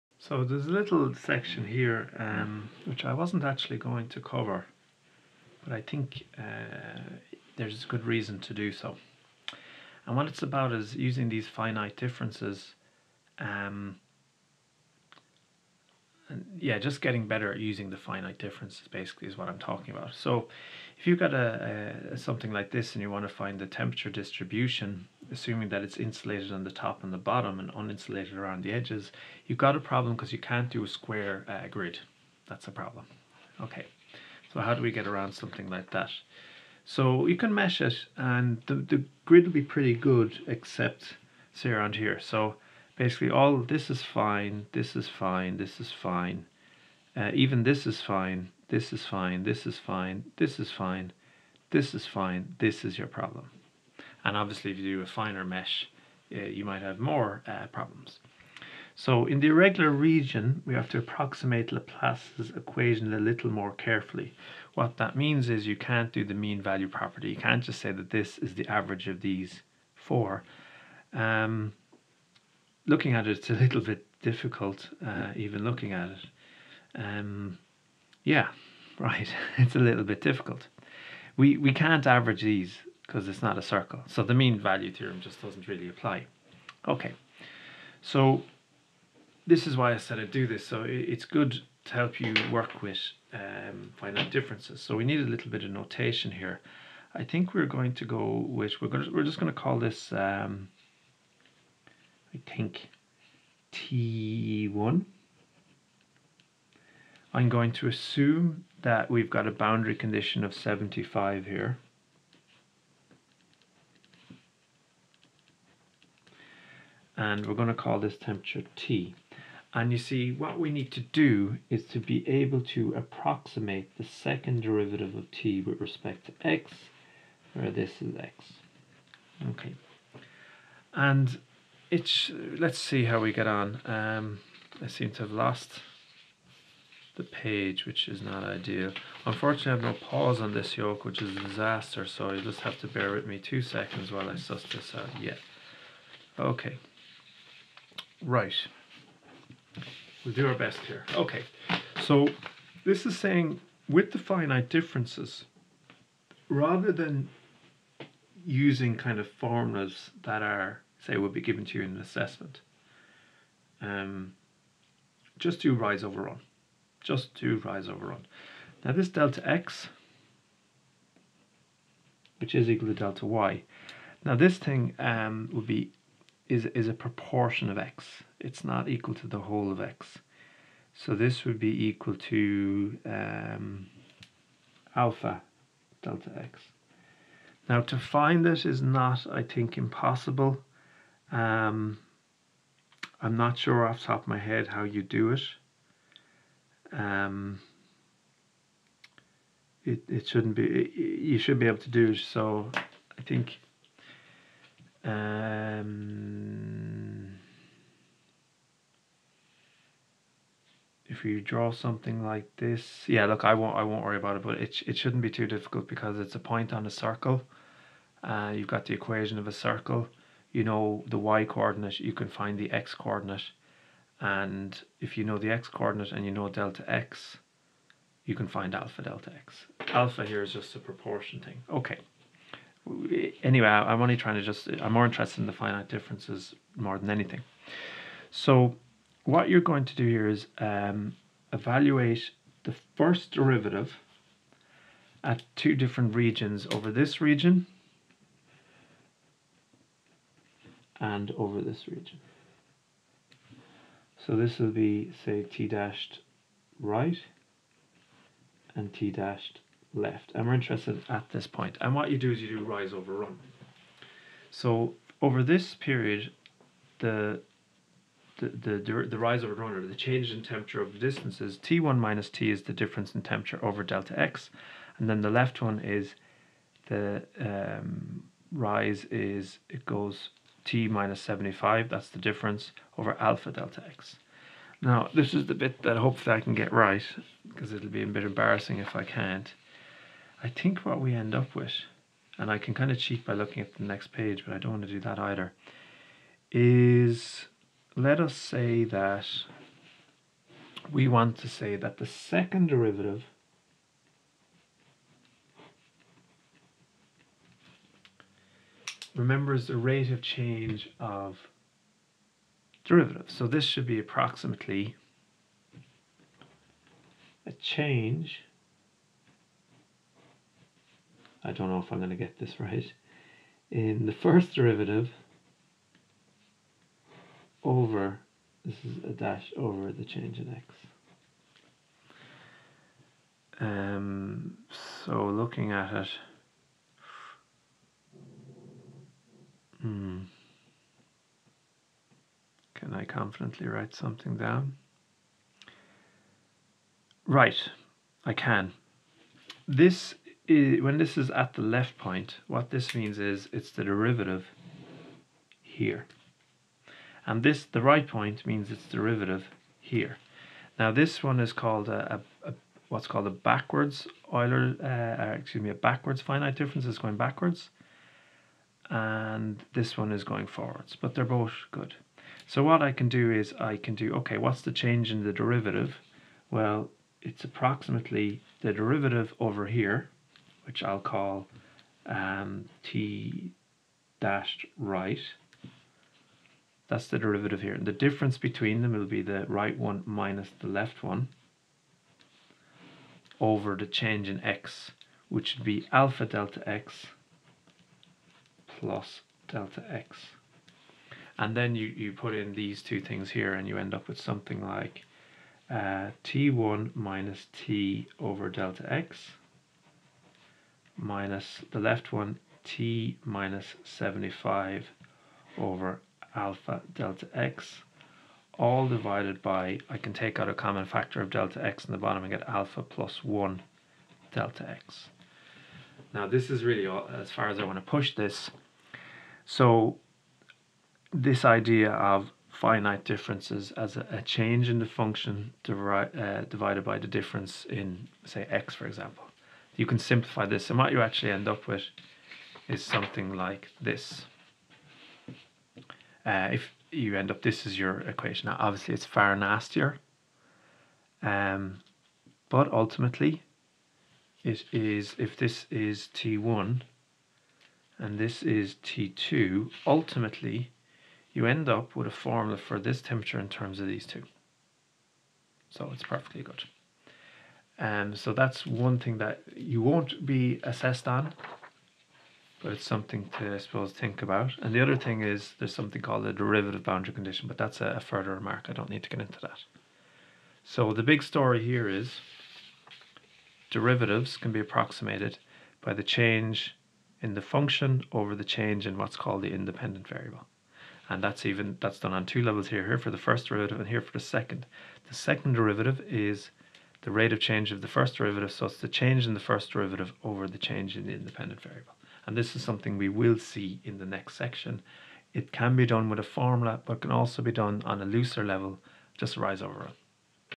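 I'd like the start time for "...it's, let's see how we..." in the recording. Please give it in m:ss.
2:11.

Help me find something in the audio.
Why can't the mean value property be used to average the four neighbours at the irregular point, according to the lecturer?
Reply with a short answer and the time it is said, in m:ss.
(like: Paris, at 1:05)
it's not a circle, at 1:23.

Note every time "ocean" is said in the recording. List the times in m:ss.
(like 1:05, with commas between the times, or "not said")
not said.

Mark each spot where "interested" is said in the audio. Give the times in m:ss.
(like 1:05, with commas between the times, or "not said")
3:55, 4:20.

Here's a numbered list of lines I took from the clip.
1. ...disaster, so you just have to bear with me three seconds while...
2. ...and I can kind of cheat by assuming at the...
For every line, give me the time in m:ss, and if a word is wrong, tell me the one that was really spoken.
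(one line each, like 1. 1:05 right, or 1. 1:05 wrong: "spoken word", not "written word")
1. 2:21 wrong: "two", not "three"
2. 4:52 wrong: "looking", not "assuming".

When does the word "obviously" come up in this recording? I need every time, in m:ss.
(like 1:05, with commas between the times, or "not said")
0:54, 7:28.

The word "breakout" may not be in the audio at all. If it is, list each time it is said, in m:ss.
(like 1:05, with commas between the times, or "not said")
not said.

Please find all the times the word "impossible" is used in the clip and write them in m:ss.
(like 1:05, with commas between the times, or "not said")
3:09.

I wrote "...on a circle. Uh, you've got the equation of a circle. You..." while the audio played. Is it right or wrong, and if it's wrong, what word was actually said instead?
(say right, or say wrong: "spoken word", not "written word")
right.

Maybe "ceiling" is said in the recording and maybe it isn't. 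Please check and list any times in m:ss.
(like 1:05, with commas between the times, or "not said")
not said.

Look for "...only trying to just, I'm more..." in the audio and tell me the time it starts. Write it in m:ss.
3:54.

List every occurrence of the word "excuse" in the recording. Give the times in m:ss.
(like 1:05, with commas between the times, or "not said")
6:05.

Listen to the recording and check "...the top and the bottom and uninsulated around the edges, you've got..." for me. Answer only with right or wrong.
right.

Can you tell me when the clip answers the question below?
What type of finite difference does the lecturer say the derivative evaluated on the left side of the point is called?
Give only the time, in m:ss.
6:05.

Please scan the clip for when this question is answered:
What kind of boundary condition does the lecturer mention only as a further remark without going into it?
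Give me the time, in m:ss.
7:56.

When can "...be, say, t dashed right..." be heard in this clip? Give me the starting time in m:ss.
4:14.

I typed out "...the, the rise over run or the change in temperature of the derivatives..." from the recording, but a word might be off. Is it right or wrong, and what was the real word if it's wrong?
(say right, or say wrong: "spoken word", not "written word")
wrong: "distances", not "derivatives".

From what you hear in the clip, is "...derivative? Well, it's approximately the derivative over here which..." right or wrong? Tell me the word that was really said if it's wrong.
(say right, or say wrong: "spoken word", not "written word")
right.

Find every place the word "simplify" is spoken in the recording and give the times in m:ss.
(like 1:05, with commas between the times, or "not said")
7:19.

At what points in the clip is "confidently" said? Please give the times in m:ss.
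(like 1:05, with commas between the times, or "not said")
5:43.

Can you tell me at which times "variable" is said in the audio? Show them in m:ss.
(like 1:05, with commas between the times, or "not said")
8:10, 8:21.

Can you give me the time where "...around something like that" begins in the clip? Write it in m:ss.
0:35.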